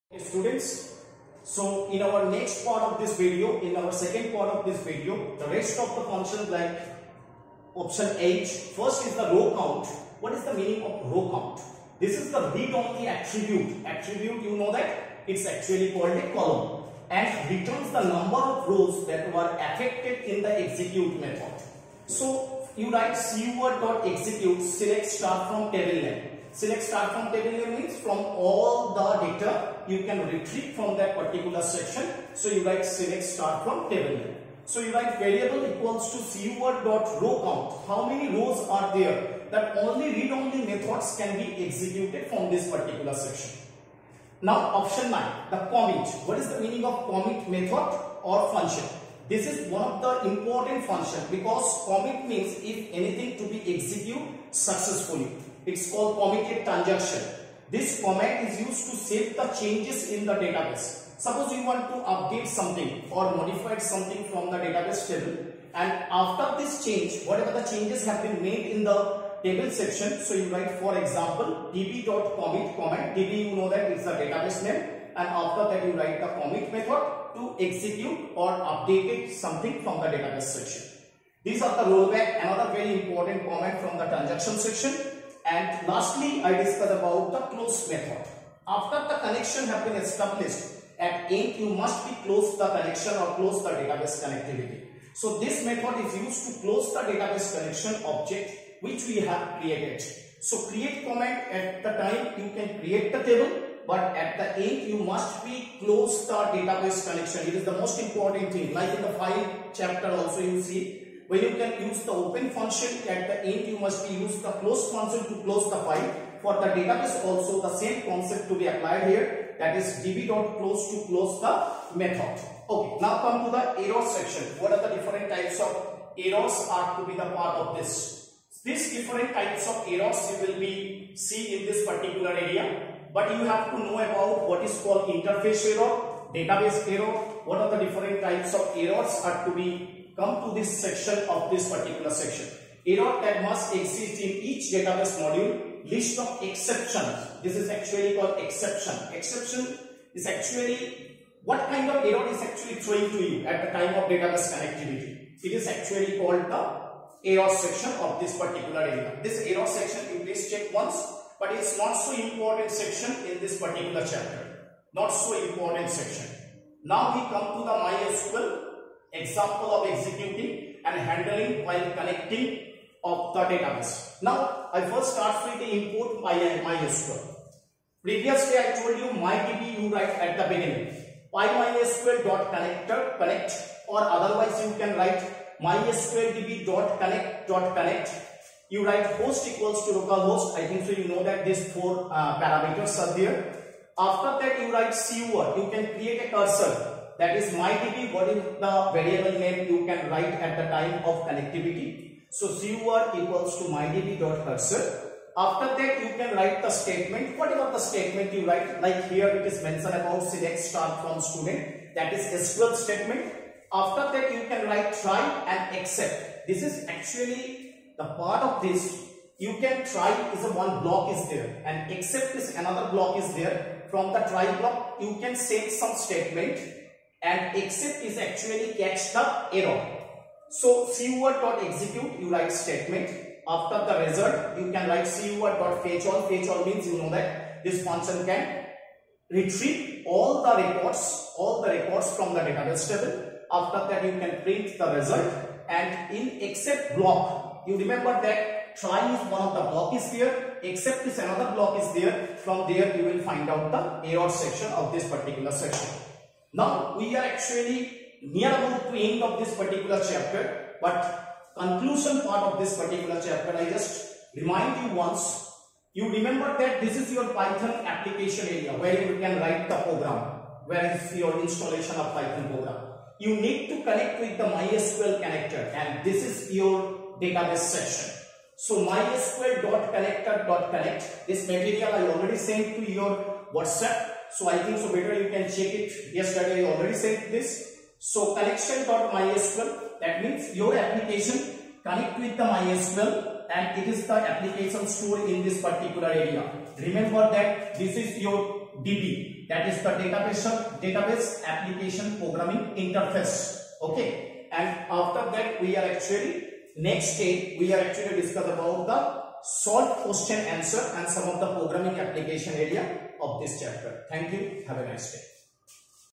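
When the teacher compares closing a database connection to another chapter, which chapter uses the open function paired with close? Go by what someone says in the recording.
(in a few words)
file chapter.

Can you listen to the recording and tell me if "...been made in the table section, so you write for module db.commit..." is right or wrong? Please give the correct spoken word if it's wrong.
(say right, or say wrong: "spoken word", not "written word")
wrong: "example", not "module".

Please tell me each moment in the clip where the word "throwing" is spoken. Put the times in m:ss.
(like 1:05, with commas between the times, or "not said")
2:32.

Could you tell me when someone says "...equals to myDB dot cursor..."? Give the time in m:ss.
3:23.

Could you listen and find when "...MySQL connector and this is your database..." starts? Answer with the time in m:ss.
4:34.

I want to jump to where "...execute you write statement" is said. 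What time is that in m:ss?
3:51.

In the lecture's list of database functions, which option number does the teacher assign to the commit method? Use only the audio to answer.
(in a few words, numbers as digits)
9.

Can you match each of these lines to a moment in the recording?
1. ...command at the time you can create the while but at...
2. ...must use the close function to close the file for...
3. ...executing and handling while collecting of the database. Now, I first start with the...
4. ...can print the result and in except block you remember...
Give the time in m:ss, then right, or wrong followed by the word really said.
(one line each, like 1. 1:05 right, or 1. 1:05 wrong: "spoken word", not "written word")
1. 1:41 wrong: "table", not "while"
2. 1:53 right
3. 2:49 right
4. 4:04 right.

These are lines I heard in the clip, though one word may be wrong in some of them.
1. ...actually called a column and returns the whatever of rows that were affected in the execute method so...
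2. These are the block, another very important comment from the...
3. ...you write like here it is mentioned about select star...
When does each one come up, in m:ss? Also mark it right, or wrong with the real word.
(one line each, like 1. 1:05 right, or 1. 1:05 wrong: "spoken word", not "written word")
1. 0:15 wrong: "number", not "whatever"
2. 1:21 wrong: "rollback", not "block"
3. 3:28 right.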